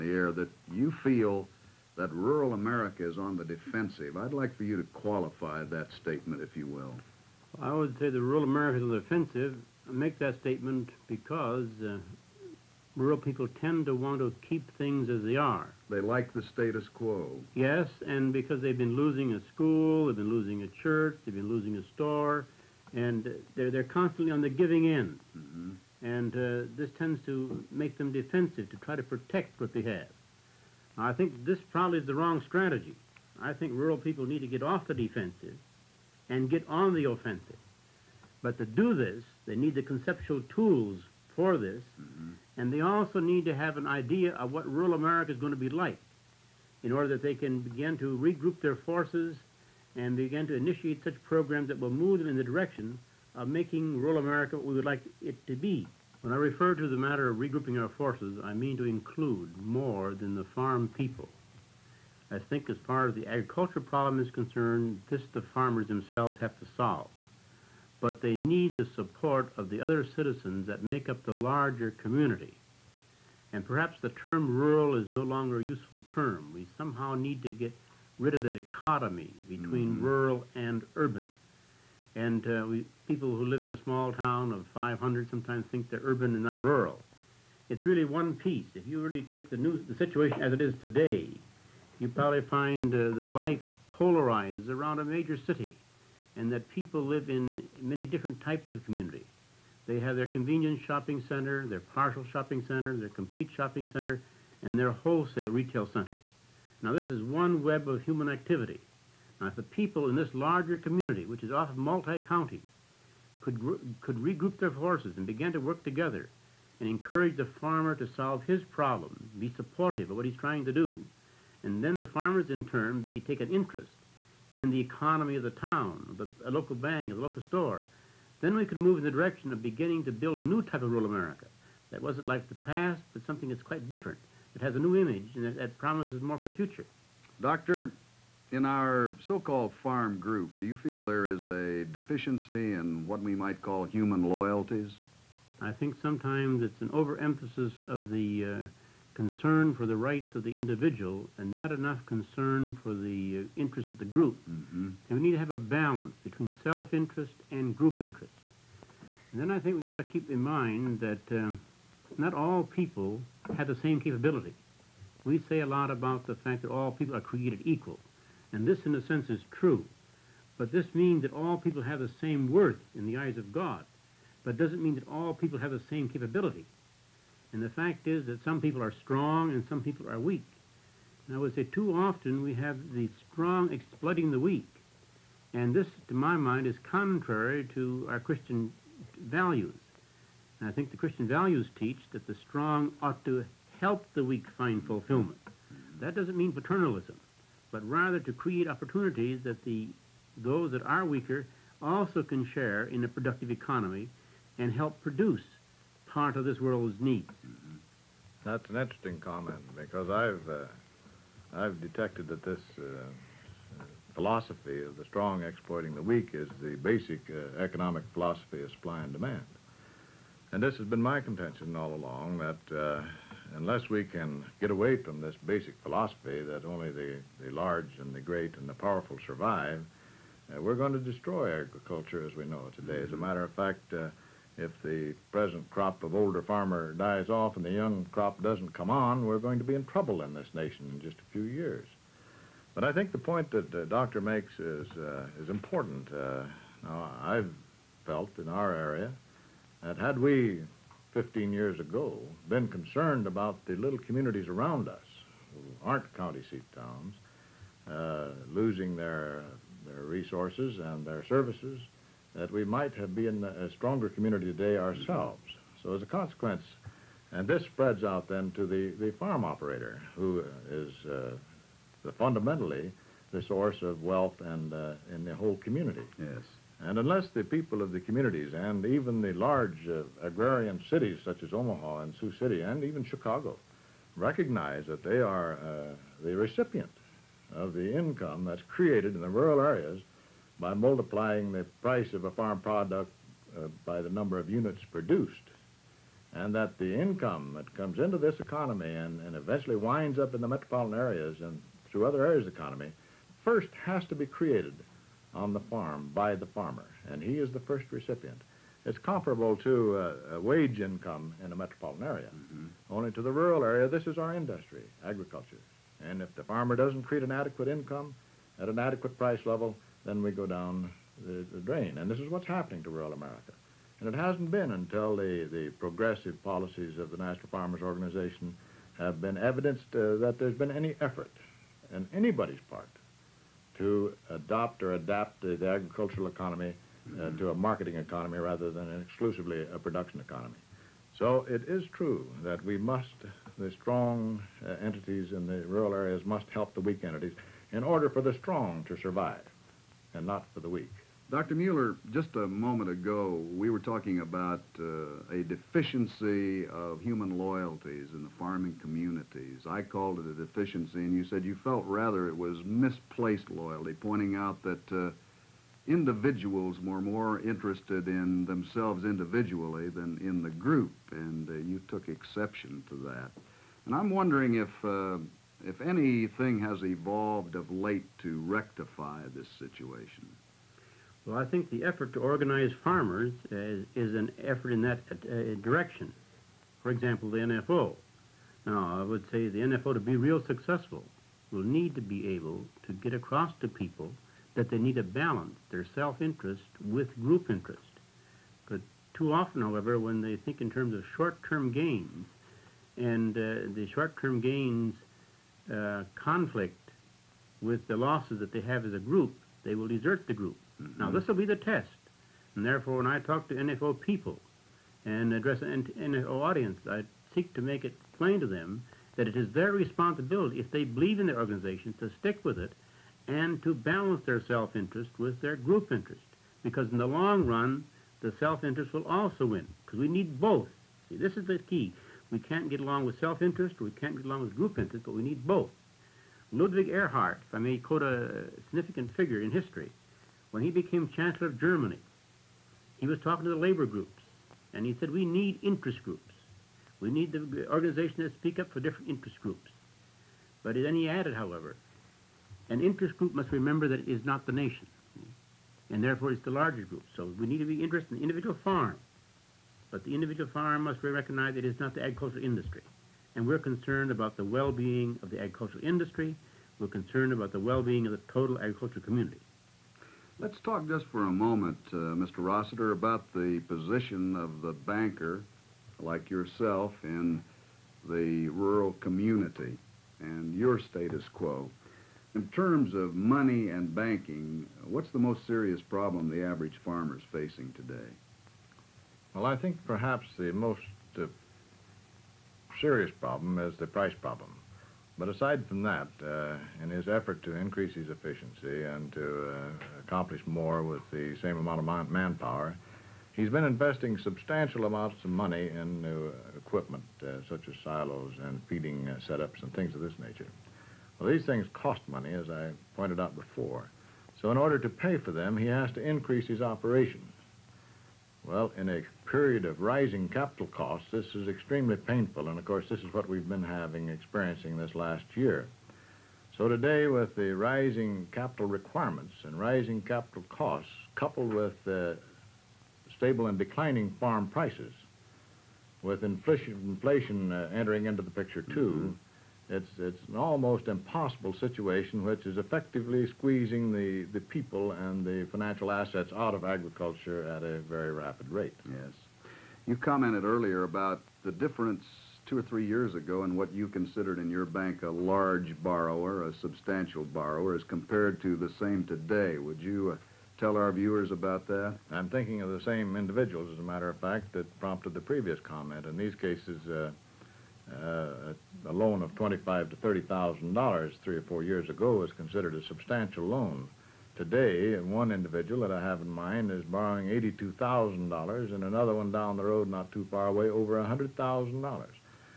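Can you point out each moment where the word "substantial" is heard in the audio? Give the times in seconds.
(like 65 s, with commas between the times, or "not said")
504 s, 556 s, 572 s.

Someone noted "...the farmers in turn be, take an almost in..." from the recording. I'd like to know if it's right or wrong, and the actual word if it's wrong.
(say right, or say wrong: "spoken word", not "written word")
wrong: "interest", not "almost".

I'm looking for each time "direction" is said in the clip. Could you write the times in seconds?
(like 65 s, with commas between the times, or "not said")
52 s, 129 s, 385 s.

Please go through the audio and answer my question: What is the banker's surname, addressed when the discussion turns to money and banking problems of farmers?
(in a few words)
Rossiter.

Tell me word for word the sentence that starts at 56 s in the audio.
When I refer to the matter of regrouping our forces, I mean to include more than the farm people.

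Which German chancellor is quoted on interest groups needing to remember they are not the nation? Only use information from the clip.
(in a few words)
Ludwig Erhard.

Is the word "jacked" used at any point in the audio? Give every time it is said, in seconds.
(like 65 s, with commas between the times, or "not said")
not said.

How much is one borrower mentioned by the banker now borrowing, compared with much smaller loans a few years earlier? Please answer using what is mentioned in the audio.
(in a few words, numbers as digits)
$82,000.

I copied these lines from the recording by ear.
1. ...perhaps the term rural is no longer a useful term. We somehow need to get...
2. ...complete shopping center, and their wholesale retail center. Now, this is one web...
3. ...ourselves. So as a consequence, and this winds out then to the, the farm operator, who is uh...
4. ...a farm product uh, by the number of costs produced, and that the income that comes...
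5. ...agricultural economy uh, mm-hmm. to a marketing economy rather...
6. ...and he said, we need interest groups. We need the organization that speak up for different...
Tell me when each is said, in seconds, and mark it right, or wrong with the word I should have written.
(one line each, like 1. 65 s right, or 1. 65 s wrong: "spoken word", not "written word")
1. 73 s right
2. 103 s right
3. 264 s wrong: "spreads", not "winds"
4. 292 s wrong: "units", not "costs"
5. 335 s right
6. 444 s right.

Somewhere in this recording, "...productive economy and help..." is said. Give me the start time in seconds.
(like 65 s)
203 s.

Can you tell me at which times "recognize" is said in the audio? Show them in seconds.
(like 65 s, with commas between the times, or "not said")
284 s, 461 s.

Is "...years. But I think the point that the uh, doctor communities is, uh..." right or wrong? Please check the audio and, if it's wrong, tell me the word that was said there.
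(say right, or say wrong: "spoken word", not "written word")
wrong: "makes", not "communities".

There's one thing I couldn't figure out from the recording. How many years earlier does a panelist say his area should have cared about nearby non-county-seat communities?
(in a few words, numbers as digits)
15.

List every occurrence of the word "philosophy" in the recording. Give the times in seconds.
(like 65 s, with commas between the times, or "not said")
214 s, 218 s, 225 s.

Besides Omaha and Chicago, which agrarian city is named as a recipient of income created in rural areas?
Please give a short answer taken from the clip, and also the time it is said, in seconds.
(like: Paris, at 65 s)
Sioux City, at 282 s.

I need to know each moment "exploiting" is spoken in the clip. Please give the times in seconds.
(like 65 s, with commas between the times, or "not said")
183 s, 215 s.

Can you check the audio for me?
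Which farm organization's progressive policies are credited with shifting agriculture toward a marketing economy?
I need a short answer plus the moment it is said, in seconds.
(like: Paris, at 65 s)
National Farmers Organization, at 327 s.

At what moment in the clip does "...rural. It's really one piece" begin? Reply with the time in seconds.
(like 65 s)
86 s.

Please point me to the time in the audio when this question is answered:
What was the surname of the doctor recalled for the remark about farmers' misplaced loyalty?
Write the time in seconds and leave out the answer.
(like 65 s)
351 s.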